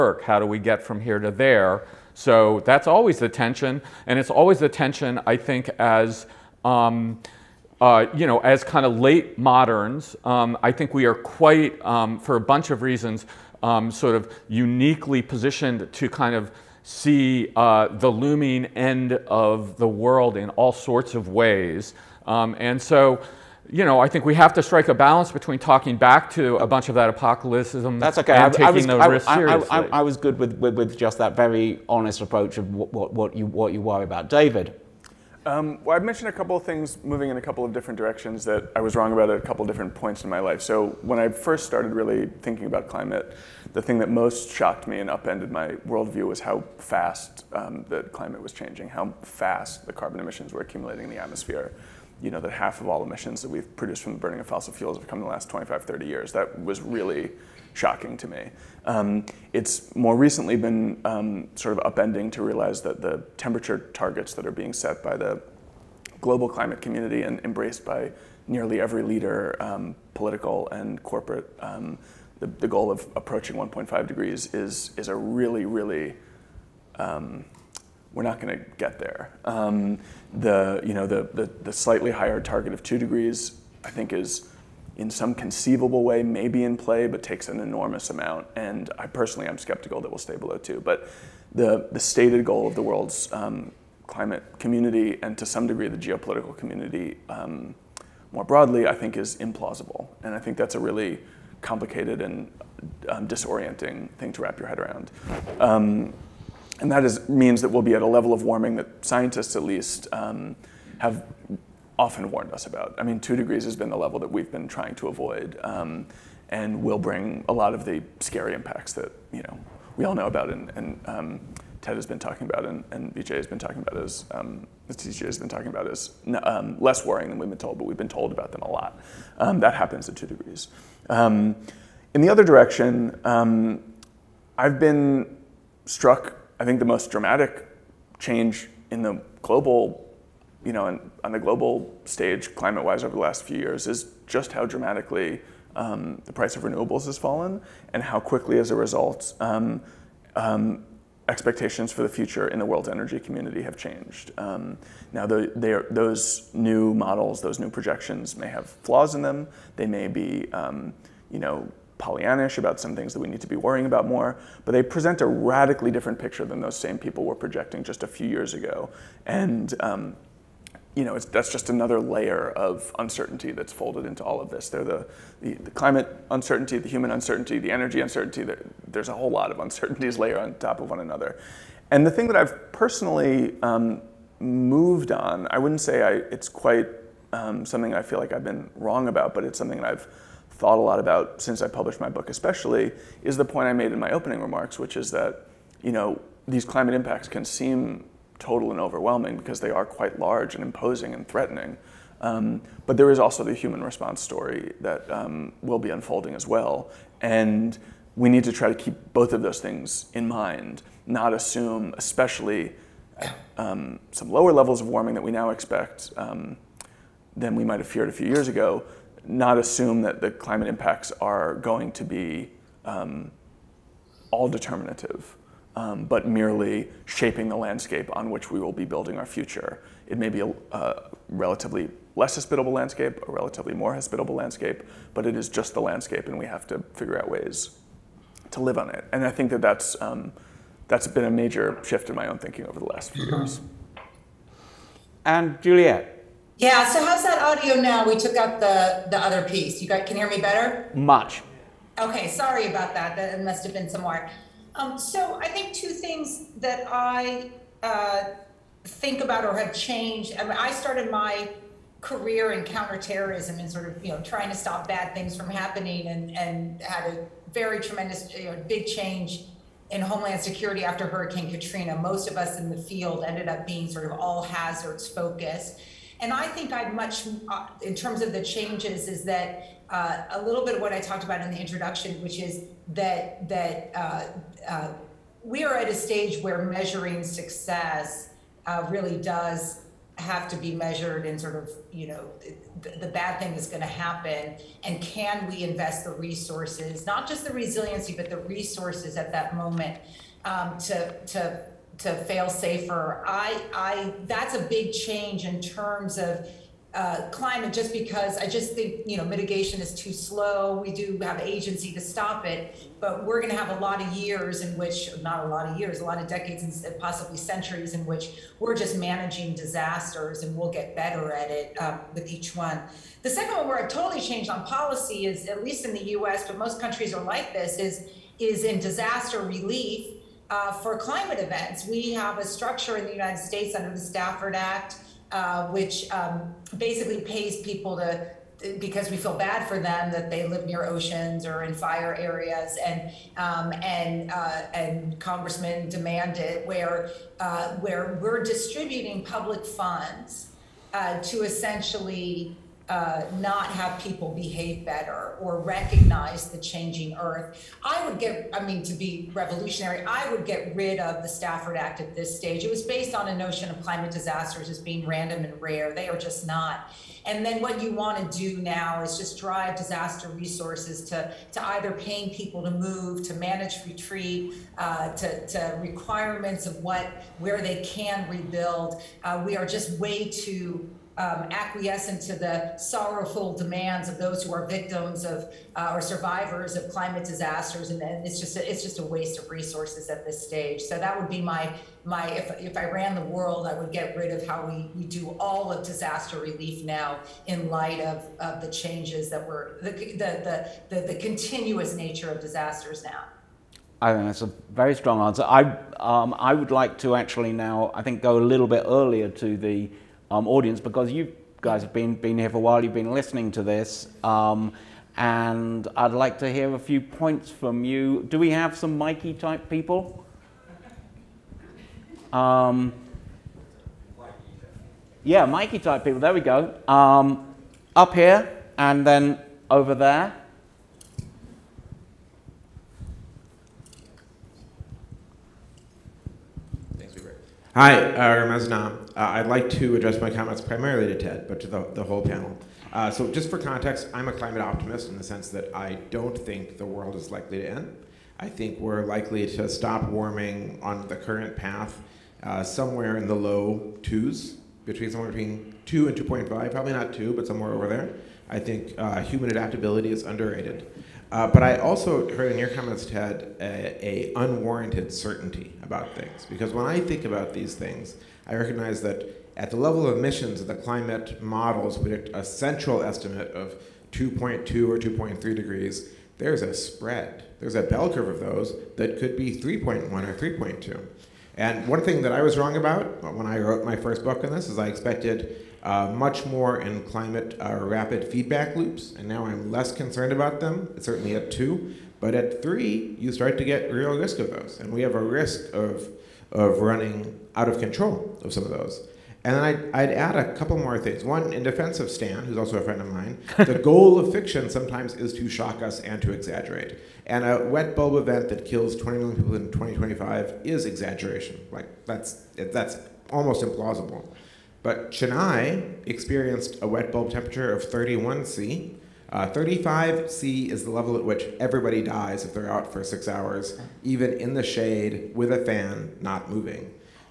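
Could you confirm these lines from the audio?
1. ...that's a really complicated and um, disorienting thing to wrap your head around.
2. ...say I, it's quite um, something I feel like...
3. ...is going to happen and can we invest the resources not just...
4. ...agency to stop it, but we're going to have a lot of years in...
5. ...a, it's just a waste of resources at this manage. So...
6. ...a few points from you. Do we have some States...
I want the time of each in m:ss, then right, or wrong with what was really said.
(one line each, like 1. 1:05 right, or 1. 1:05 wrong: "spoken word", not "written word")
1. 1:40 right
2. 3:05 right
3. 4:53 right
4. 5:11 right
5. 6:28 wrong: "stage", not "manage"
6. 6:56 wrong: "Mikey", not "States".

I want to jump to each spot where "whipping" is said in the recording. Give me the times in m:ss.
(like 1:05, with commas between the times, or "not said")
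not said.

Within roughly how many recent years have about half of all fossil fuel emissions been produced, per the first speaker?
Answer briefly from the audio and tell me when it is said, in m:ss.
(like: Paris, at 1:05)
25, 30 years, at 0:55.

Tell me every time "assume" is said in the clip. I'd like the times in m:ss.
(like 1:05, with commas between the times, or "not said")
3:31, 3:39.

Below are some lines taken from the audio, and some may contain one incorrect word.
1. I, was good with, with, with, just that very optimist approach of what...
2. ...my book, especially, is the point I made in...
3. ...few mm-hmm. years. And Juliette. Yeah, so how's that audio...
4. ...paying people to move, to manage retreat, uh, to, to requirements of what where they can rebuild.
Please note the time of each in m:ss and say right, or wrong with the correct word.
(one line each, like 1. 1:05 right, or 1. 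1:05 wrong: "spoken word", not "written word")
1. 0:29 wrong: "honest", not "optimist"
2. 3:11 right
3. 4:03 right
4. 6:11 right.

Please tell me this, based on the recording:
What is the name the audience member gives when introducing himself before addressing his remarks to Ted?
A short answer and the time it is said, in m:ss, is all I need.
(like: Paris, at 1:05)
Ramez, at 7:18.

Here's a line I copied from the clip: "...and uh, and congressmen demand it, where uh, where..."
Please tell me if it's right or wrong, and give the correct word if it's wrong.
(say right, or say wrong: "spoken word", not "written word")
right.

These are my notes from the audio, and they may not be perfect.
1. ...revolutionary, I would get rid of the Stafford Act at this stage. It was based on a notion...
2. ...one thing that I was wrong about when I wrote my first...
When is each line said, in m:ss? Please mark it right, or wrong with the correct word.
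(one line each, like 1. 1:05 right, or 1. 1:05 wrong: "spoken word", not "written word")
1. 5:59 right
2. 8:01 right.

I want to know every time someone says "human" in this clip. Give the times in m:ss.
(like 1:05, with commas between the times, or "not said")
2:56, 3:23, 7:39.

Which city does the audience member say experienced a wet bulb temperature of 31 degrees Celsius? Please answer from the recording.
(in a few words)
Chennai.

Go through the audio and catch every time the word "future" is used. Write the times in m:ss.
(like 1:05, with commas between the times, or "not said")
2:32, 3:49.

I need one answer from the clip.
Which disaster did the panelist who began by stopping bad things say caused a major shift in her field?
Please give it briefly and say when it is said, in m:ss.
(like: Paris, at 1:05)
Hurricane Katrina, at 4:31.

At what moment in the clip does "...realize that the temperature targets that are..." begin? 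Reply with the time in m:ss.
1:02.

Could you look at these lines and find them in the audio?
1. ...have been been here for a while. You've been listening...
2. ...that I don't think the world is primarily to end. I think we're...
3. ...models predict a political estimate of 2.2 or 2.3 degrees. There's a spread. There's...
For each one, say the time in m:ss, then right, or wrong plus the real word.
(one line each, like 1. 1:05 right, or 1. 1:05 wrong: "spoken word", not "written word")
1. 6:51 right
2. 7:25 wrong: "likely", not "primarily"
3. 7:51 wrong: "central", not "political".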